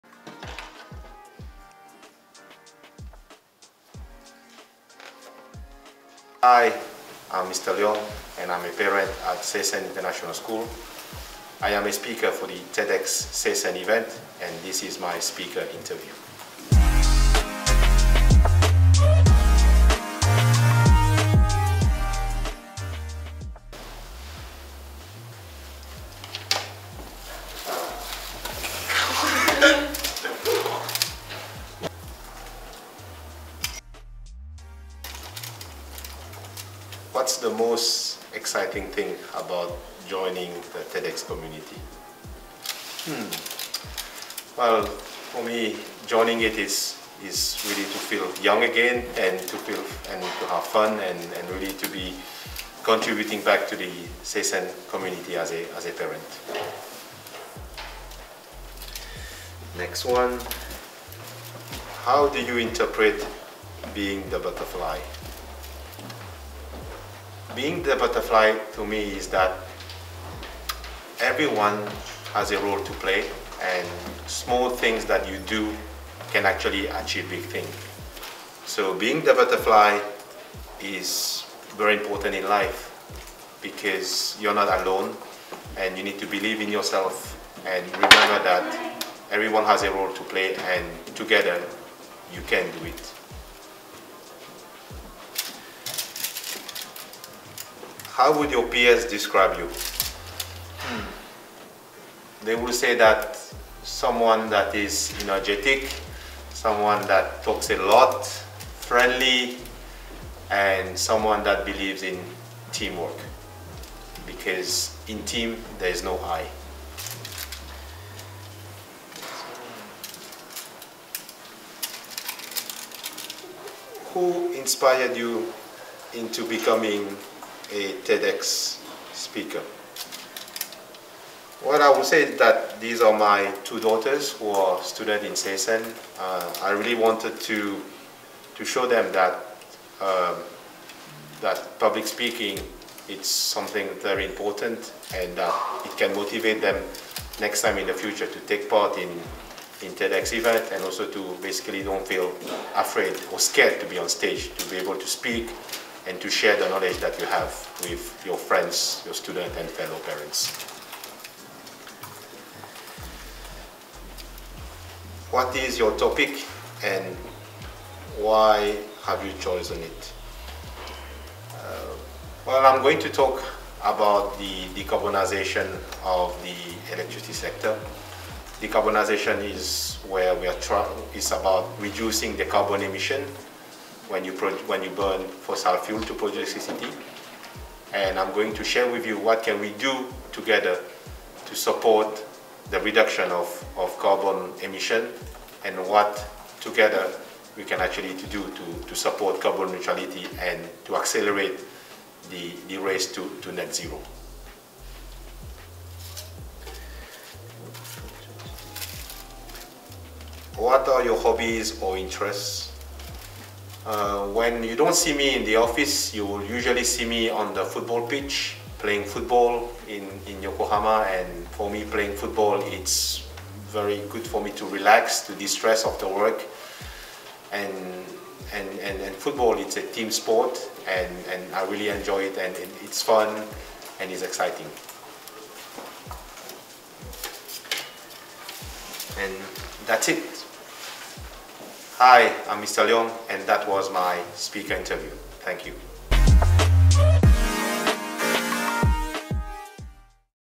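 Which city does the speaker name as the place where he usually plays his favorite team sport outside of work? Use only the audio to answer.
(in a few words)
Yokohama.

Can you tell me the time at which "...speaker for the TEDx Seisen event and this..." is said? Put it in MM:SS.
00:11.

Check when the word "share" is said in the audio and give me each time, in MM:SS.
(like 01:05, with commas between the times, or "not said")
02:36, 03:08.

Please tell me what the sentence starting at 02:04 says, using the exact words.
Who inspired you into becoming a TEDx speaker.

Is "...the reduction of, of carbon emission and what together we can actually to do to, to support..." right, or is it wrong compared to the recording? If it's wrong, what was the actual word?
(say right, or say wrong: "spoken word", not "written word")
right.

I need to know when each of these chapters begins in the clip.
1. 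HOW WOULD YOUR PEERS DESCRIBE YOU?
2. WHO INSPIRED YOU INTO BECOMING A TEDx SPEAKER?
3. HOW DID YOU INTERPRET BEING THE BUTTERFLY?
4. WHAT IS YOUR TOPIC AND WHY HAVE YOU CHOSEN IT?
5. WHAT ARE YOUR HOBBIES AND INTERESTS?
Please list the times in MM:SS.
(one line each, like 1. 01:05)
1. 01:37
2. 02:04
3. 01:01
4. 02:45
5. 03:30.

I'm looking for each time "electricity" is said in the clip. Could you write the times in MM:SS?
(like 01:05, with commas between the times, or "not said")
02:56, 03:06.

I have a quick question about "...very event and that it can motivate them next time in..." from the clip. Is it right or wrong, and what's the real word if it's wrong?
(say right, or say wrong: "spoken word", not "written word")
wrong: "important", not "event".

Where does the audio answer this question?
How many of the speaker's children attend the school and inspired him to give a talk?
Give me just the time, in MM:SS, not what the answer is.
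02:13.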